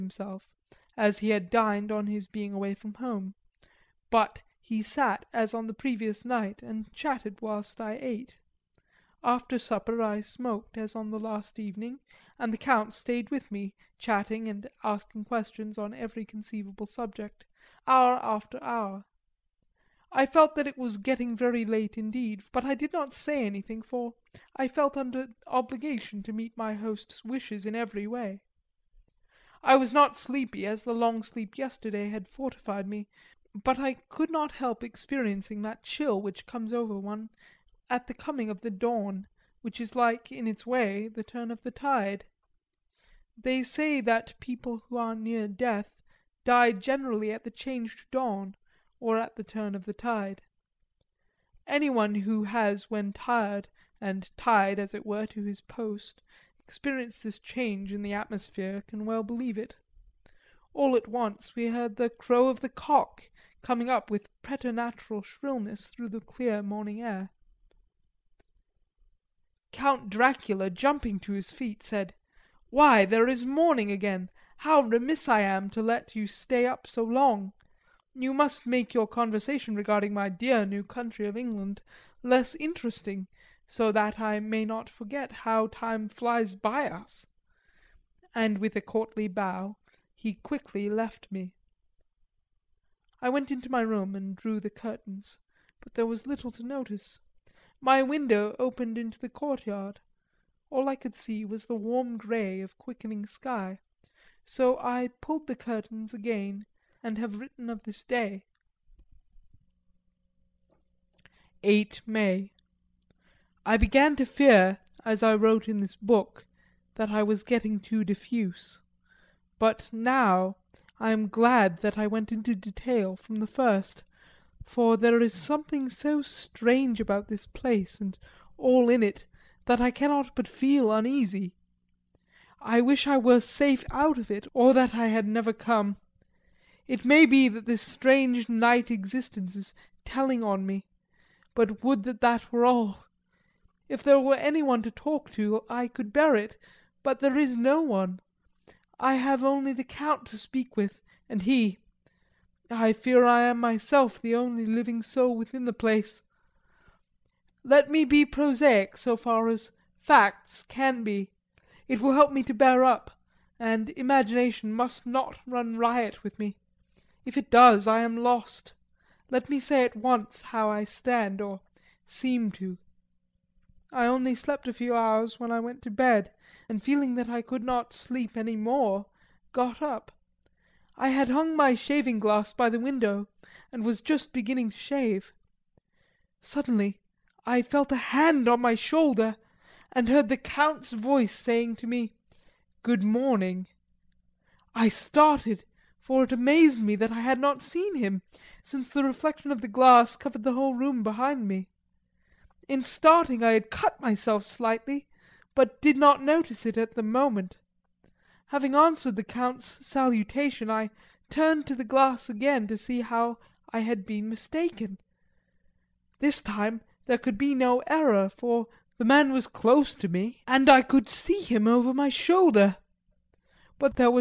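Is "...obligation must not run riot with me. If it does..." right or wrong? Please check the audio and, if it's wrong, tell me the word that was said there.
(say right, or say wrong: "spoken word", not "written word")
wrong: "imagination", not "obligation".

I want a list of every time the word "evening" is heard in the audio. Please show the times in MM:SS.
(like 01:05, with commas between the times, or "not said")
00:11.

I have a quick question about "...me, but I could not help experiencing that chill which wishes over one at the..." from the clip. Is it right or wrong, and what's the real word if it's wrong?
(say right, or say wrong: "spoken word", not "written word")
wrong: "comes", not "wishes".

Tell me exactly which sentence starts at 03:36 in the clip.
This time there could be no error, for the man was close to me, and I could see him over my shoulder.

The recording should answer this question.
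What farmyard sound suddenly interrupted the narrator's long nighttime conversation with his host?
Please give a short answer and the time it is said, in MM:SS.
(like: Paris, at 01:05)
the crow of the cock, at 01:01.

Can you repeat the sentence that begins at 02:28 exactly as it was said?
I have only the Count to speak with, and he, I fear I am myself the only living soul within the place.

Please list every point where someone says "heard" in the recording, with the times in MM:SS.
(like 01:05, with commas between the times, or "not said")
01:01, 03:10.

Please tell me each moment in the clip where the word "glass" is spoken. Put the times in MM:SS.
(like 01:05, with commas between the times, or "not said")
03:02, 03:19, 03:31.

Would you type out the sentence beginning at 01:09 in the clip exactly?
Count Dracula, jumping to his feet, said: "Why, there is morning again!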